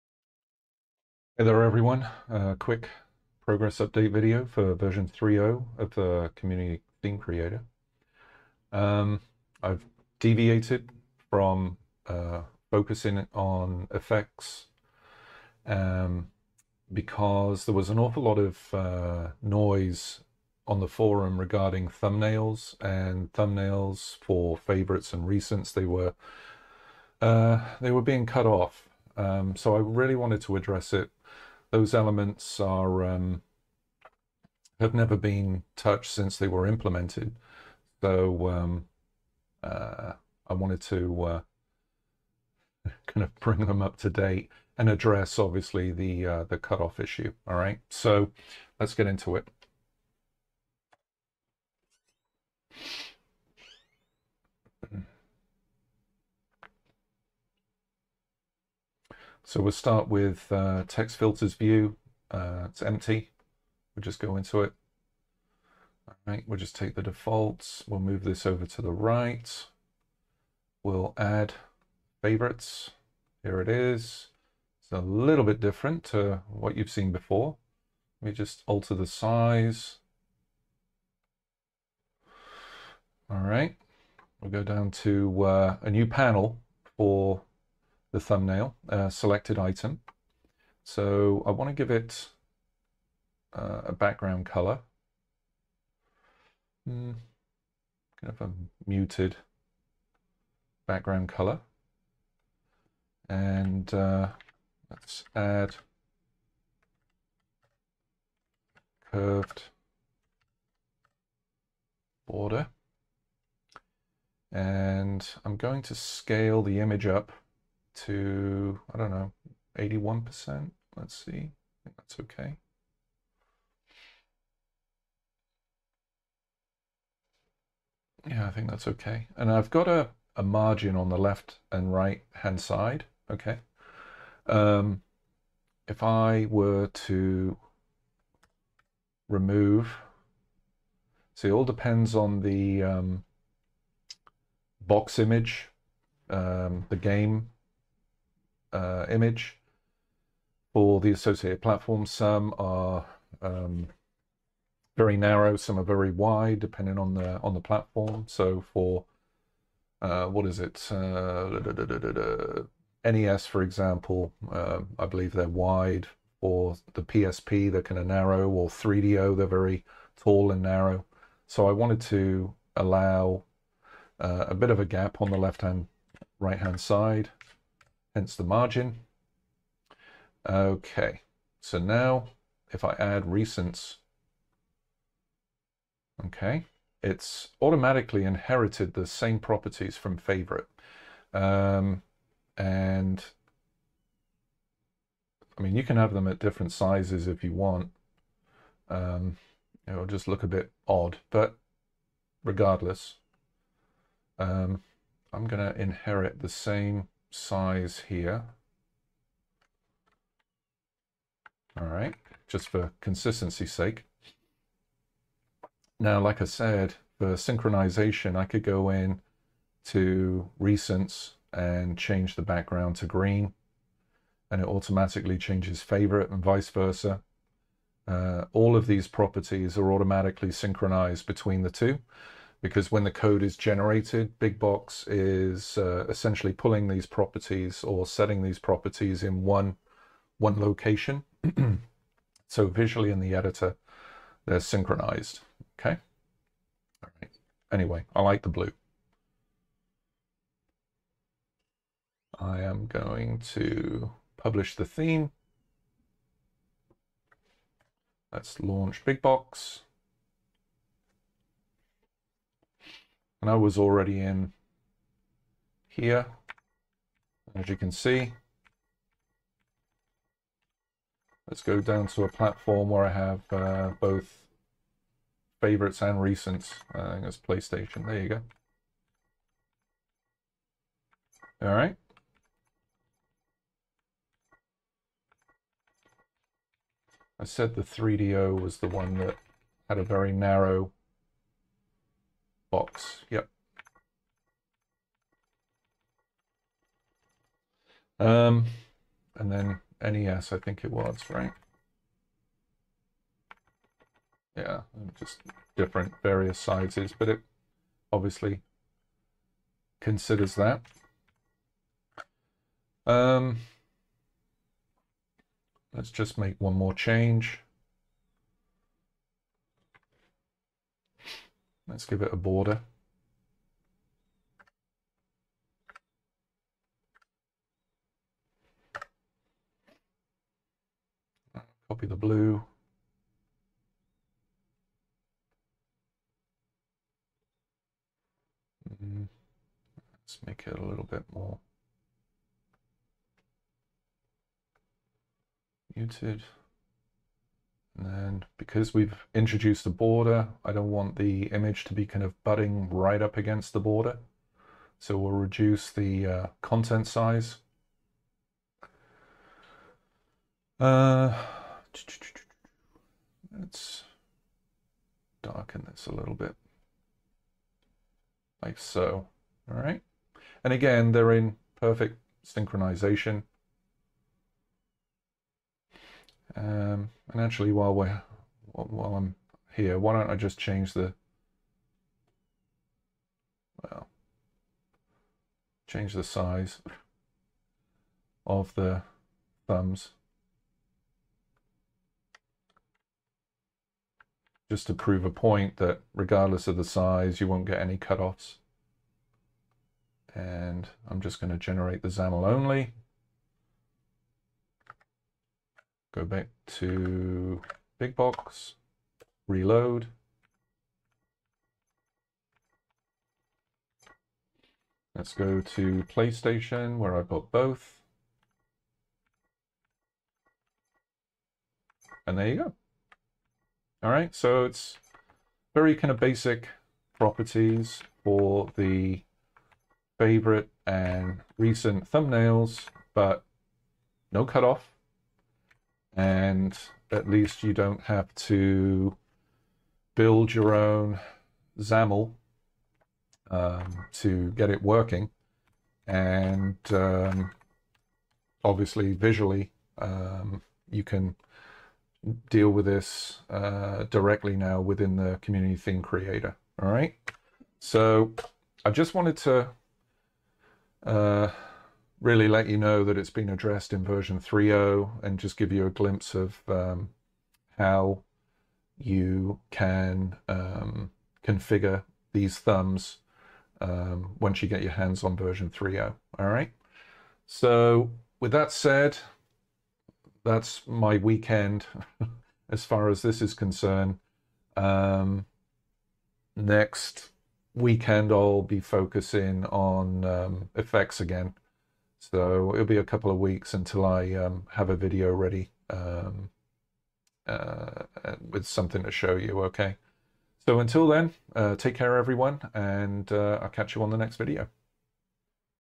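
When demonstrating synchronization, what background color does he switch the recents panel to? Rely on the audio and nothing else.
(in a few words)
Green.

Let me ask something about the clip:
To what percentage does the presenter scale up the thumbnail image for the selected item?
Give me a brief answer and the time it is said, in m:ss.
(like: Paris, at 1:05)
81%, at 1:59.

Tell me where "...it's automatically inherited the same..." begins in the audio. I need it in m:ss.
3:07.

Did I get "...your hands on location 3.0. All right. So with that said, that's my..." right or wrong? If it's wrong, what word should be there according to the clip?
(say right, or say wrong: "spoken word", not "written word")
wrong: "version", not "location".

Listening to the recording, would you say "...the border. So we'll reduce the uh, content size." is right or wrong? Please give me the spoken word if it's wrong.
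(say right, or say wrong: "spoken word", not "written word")
right.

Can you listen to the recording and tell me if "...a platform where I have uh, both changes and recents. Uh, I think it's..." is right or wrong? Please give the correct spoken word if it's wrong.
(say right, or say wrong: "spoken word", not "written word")
wrong: "favorites", not "changes".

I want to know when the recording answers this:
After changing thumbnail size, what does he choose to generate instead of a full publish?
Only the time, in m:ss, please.
6:42.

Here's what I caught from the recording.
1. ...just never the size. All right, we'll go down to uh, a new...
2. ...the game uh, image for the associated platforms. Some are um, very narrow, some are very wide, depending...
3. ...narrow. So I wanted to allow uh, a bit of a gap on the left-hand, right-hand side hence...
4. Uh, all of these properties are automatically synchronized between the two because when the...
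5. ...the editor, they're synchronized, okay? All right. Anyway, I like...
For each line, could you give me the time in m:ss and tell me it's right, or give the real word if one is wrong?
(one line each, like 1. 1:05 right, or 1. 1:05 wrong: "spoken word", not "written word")
1. 1:18 wrong: "alter", not "never"
2. 2:26 right
3. 2:50 right
4. 3:48 right
5. 4:03 right.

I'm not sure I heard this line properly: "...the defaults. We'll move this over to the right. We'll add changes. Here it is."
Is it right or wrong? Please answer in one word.
wrong.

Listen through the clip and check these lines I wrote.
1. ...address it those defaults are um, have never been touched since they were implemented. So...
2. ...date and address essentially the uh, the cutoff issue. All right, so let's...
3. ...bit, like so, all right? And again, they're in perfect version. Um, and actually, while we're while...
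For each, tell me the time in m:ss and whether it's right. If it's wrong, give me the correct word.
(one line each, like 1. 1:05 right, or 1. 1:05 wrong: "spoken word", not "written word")
1. 0:30 wrong: "elements", not "defaults"
2. 0:44 wrong: "obviously", not "essentially"
3. 6:06 wrong: "synchronization", not "version".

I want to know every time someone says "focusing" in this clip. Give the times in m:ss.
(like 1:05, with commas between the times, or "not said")
0:12, 8:08.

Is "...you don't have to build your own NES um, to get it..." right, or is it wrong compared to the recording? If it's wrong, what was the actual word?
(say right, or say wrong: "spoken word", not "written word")
wrong: "XAML", not "NES".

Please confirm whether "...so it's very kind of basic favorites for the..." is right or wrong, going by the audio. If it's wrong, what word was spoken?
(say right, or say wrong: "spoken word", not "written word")
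wrong: "properties", not "favorites".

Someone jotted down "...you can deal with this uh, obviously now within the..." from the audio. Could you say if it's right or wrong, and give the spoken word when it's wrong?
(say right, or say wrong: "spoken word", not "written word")
wrong: "directly", not "obviously".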